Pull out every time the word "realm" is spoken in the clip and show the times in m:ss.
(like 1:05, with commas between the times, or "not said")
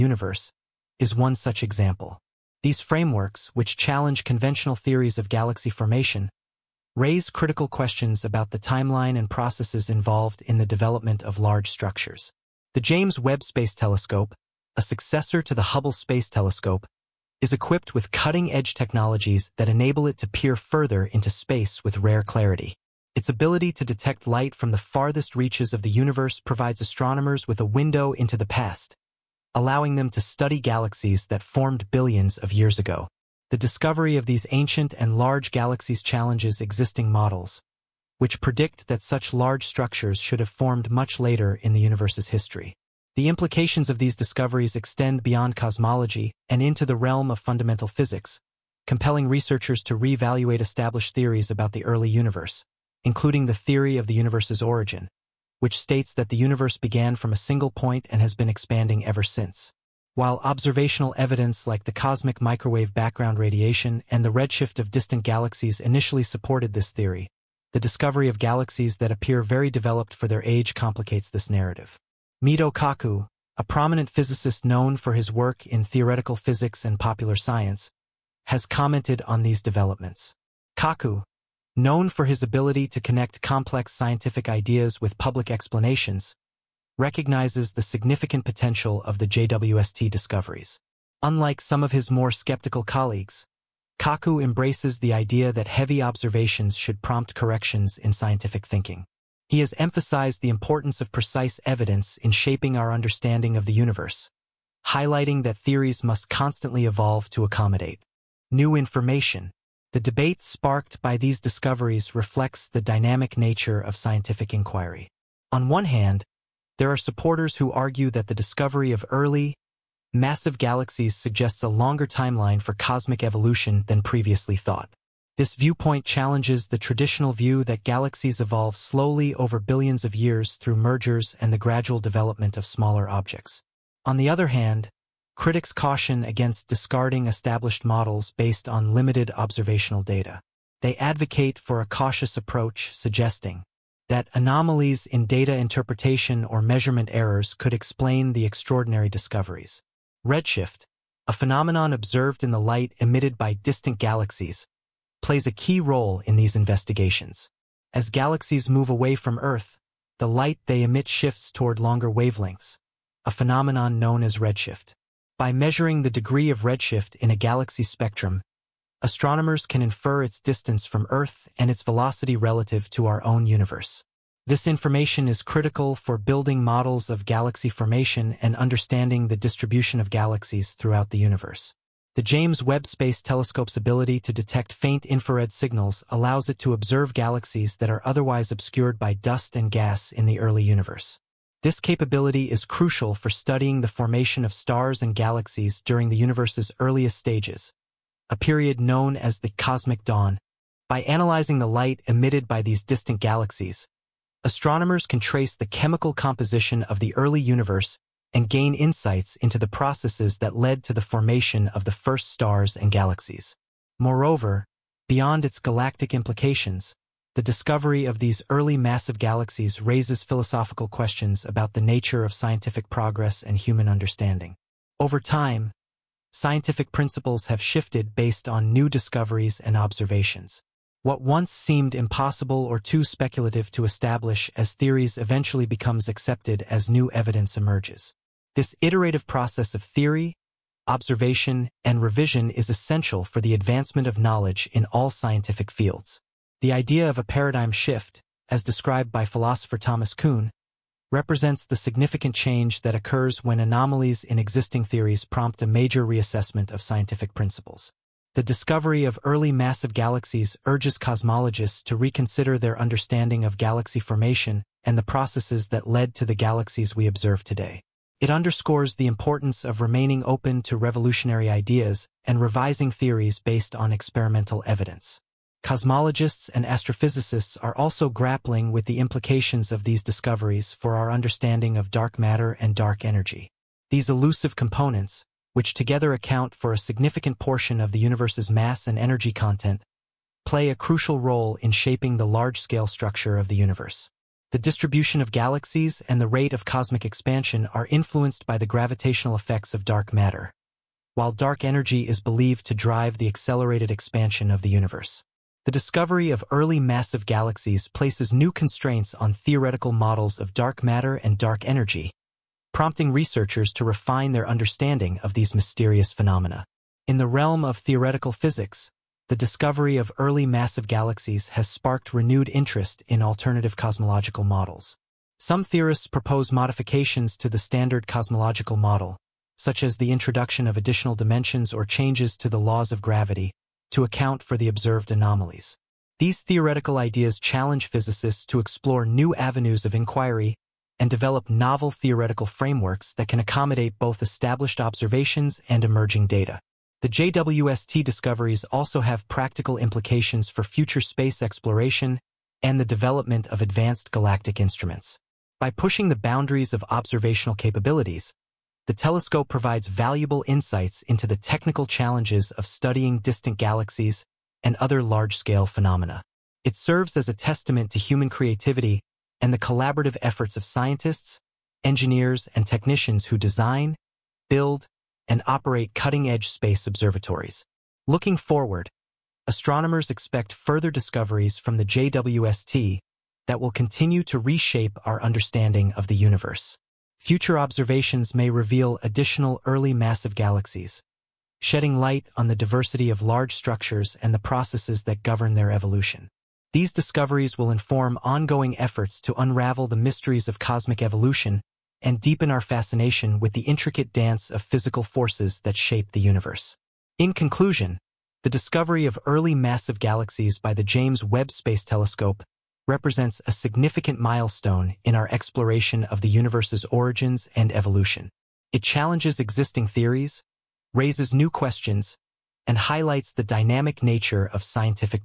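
0:46, 5:17.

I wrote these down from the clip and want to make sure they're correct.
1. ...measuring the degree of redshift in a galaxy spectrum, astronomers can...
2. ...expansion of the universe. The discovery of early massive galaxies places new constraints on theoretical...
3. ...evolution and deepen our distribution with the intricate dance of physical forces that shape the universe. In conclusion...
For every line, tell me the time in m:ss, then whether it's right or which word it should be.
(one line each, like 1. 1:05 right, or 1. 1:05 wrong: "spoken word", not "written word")
1. 2:45 right
2. 5:03 right
3. 6:41 wrong: "fascination", not "distribution".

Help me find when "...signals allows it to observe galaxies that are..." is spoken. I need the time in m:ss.
3:05.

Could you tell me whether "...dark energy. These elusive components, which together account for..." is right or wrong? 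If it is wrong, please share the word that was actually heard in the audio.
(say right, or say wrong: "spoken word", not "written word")
right.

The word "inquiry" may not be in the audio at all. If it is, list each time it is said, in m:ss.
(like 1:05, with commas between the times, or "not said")
1:54, 5:39.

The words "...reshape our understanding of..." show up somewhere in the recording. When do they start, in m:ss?
6:24.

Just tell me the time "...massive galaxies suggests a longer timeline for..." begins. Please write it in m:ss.
2:00.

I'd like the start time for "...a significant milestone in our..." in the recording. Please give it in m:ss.
6:53.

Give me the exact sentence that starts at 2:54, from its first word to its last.
This information is critical for building models of galaxy formation and understanding the distribution of galaxies throughout the universe.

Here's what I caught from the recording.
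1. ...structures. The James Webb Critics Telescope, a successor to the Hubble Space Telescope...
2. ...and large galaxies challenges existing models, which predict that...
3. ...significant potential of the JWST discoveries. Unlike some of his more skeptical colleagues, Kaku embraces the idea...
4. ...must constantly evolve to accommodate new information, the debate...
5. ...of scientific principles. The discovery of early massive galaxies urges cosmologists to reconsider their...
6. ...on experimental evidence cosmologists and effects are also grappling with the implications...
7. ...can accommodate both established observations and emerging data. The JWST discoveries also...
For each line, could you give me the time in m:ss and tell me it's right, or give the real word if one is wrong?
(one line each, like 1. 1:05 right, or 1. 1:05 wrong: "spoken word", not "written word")
1. 0:11 wrong: "Space", not "Critics"
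2. 0:34 right
3. 1:27 right
4. 1:46 right
5. 4:16 right
6. 4:33 wrong: "astrophysicists", not "effects"
7. 5:43 right.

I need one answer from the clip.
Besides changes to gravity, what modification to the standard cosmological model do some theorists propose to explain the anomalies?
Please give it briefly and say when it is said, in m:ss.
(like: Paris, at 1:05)
Additional dimensions, at 5:30.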